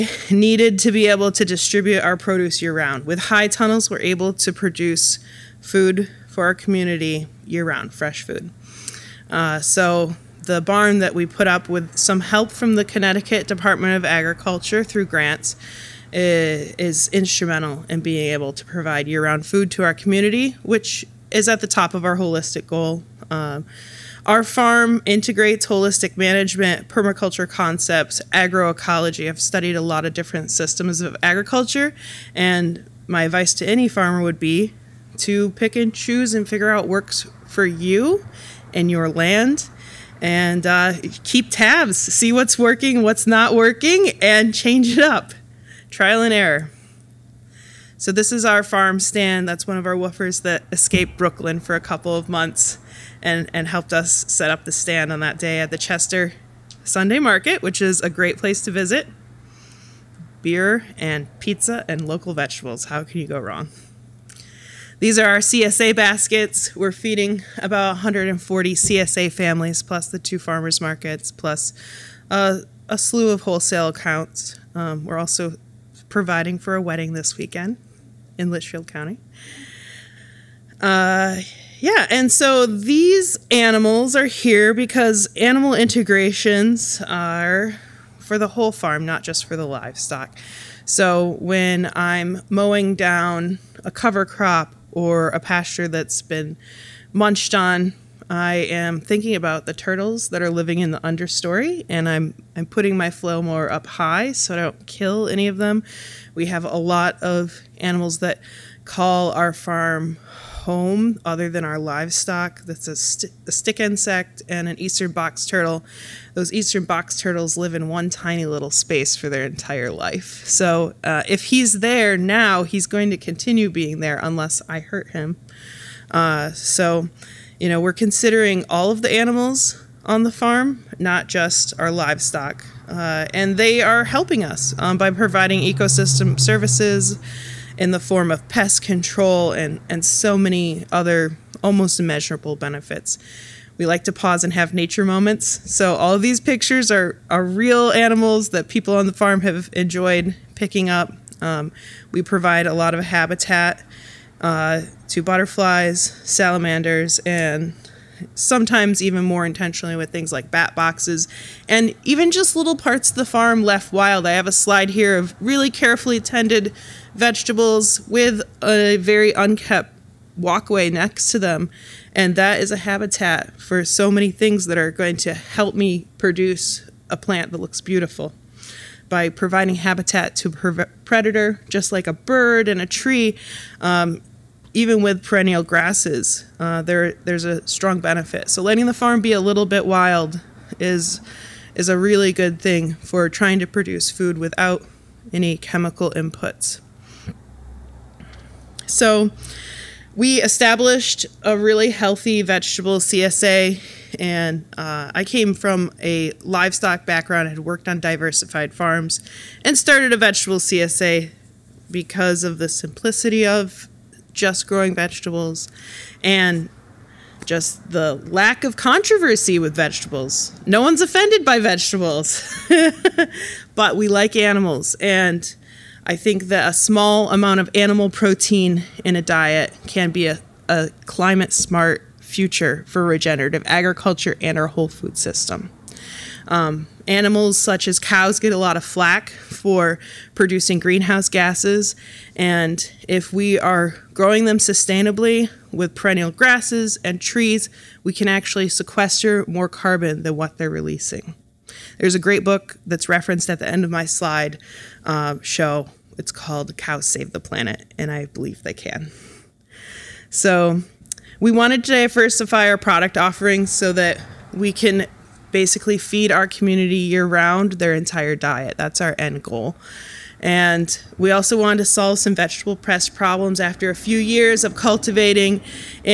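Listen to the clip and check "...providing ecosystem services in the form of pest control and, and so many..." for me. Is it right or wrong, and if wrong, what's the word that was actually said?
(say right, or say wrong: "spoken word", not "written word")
right.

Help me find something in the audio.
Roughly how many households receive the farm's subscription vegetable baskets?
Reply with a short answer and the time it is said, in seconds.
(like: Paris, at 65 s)
140, at 67 s.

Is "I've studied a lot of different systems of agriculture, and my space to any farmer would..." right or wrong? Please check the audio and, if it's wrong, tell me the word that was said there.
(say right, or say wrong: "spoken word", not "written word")
wrong: "advice", not "space".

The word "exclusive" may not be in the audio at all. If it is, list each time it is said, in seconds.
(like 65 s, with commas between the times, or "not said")
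not said.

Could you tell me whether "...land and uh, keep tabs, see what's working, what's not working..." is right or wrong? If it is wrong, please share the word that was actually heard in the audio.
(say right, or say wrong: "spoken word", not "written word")
right.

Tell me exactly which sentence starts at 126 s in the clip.
Uh, so, you know, we're considering all of the animals on the farm, not just our livestock.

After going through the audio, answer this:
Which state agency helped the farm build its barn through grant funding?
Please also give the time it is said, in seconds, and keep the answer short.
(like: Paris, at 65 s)
Connecticut Department of Agriculture, at 12 s.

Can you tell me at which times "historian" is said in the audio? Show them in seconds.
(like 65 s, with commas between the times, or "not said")
not said.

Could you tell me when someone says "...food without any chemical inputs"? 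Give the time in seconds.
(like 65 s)
194 s.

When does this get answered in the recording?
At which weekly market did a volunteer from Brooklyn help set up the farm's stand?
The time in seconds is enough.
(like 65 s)
55 s.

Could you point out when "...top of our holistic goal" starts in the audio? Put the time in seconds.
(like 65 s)
21 s.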